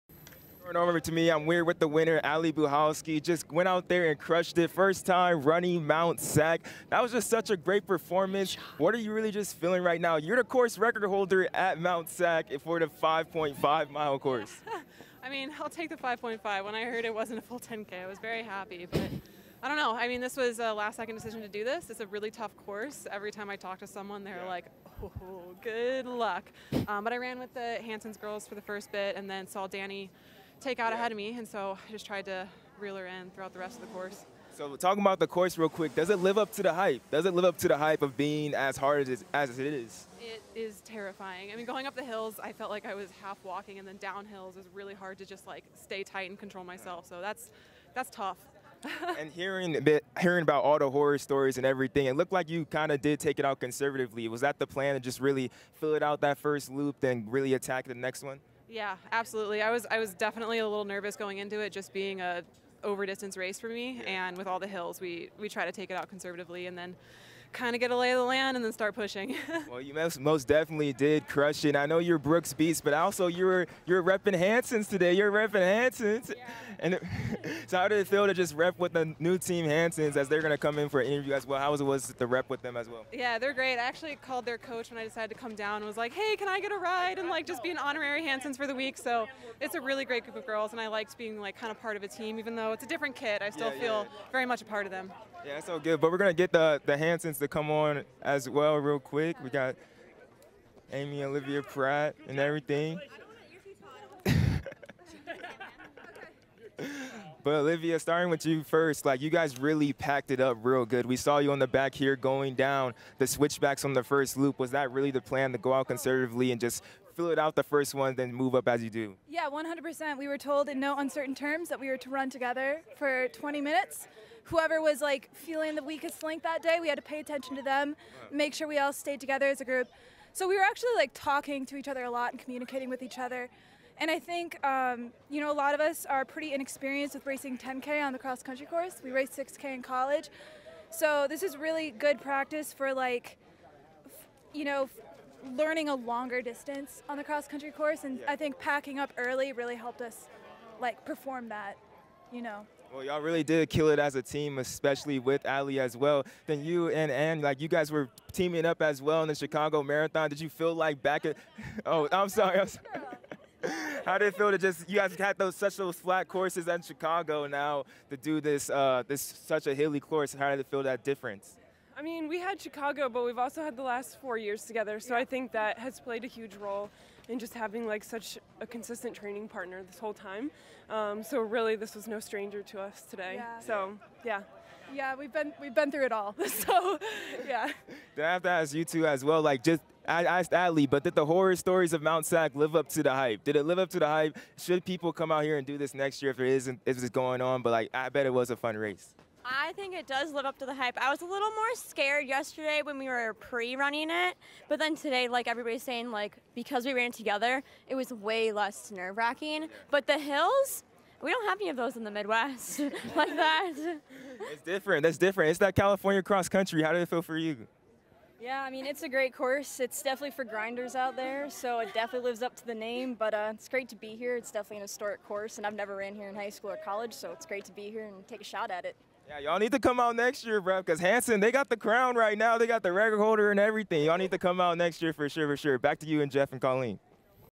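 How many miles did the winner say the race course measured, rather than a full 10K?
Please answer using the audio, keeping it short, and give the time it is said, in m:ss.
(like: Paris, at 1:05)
5.5 miles, at 0:12.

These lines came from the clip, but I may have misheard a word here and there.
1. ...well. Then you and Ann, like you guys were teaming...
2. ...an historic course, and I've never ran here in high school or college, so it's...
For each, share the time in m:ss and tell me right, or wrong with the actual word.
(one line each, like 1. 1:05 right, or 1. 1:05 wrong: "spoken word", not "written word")
1. 2:35 right
2. 3:44 right.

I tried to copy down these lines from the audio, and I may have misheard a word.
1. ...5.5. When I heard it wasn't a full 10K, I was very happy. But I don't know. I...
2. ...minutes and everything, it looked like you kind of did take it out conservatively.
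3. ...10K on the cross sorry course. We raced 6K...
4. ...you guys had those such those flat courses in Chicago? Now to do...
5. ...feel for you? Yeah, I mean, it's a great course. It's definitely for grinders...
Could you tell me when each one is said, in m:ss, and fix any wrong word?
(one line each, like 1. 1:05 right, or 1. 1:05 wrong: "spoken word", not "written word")
1. 0:15 right
2. 0:51 wrong: "stories", not "minutes"
3. 2:17 wrong: "country", not "sorry"
4. 2:44 right
5. 3:37 right.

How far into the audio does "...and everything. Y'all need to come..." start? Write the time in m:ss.
3:53.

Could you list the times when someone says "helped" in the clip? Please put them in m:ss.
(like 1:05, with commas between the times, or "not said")
2:29.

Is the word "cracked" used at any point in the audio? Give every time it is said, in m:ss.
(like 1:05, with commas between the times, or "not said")
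not said.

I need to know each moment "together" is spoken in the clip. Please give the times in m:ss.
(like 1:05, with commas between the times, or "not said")
2:02, 2:09, 2:54, 3:27.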